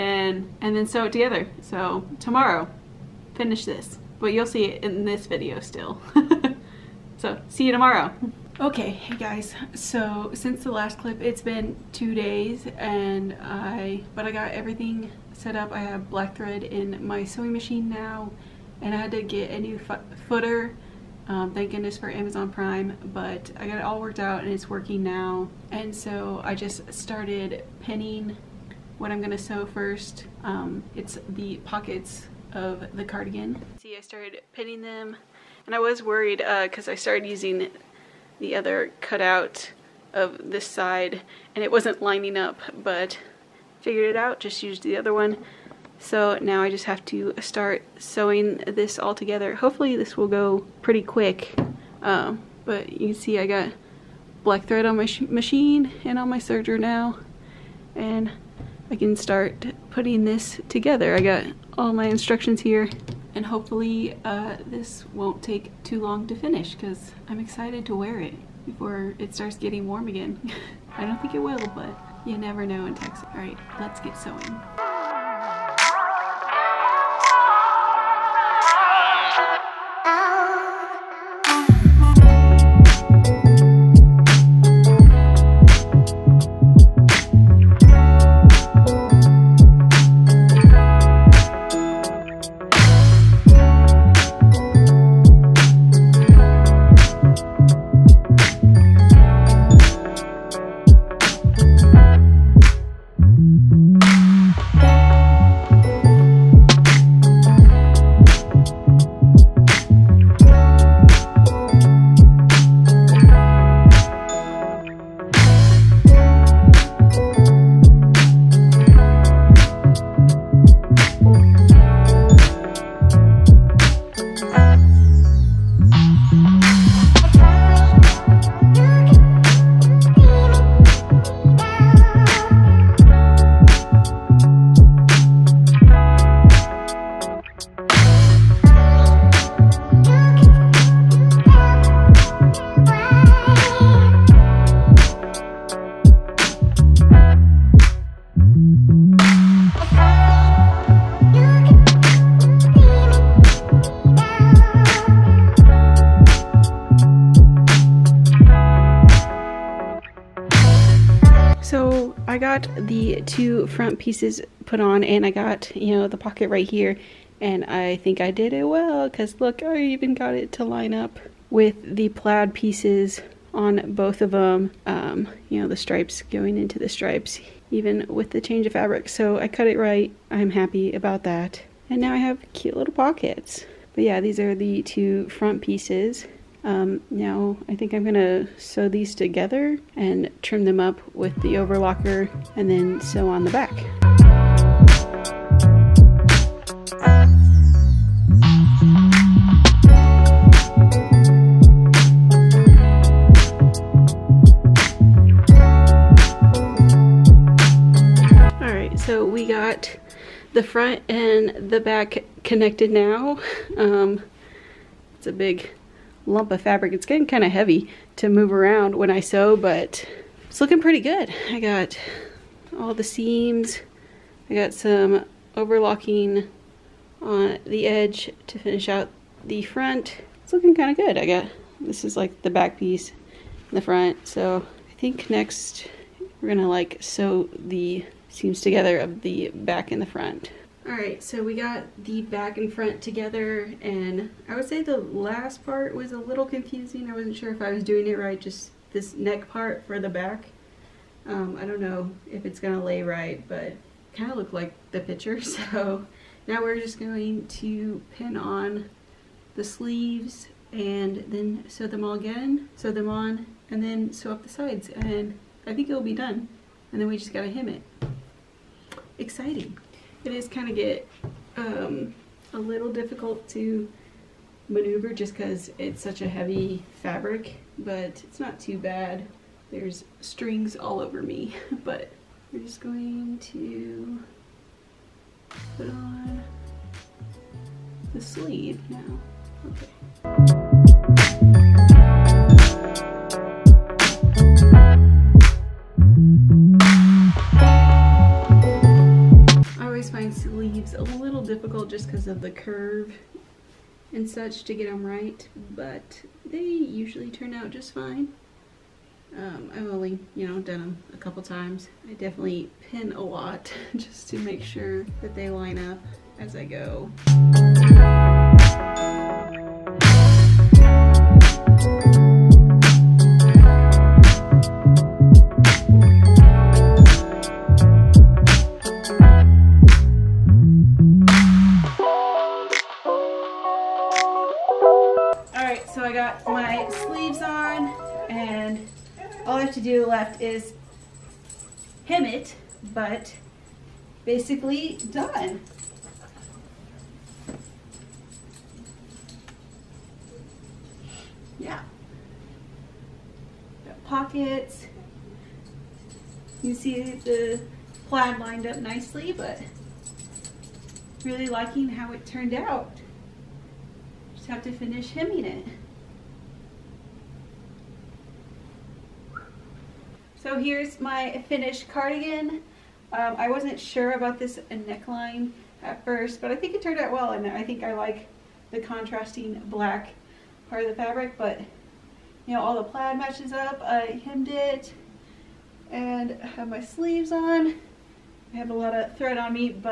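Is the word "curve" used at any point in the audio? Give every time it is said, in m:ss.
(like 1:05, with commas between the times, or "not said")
5:02.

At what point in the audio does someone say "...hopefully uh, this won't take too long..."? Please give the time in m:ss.
1:03.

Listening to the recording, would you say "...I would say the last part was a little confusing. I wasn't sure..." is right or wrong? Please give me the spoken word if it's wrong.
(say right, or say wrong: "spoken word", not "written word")
right.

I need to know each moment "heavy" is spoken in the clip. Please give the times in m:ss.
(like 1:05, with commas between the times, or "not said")
3:37, 4:36.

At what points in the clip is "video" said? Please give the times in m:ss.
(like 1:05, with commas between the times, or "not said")
0:05.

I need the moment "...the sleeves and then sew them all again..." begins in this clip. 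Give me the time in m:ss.
4:19.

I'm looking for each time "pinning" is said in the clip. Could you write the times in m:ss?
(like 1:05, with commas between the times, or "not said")
0:27, 0:34.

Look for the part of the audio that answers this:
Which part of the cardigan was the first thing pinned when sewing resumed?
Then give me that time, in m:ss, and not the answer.
0:31.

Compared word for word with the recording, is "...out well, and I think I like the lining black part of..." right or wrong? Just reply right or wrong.
wrong.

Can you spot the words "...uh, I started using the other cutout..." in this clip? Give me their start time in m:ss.
0:36.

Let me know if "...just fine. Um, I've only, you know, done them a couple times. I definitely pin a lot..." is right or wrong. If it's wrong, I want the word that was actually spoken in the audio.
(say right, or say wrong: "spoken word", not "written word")
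right.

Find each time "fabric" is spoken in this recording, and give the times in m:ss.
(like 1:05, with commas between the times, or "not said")
2:58, 3:36, 4:37, 6:20.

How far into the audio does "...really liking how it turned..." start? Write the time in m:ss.
6:01.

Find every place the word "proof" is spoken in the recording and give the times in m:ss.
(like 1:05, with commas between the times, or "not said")
not said.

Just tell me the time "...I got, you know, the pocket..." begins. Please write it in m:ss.
2:45.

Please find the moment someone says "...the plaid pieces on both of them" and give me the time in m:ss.
2:51.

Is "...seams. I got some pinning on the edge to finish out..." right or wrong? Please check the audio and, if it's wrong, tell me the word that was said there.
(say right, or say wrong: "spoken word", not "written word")
wrong: "overlocking", not "pinning".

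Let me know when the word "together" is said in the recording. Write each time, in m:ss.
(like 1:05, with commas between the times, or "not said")
0:01, 0:49, 1:00, 3:09, 3:58, 4:03.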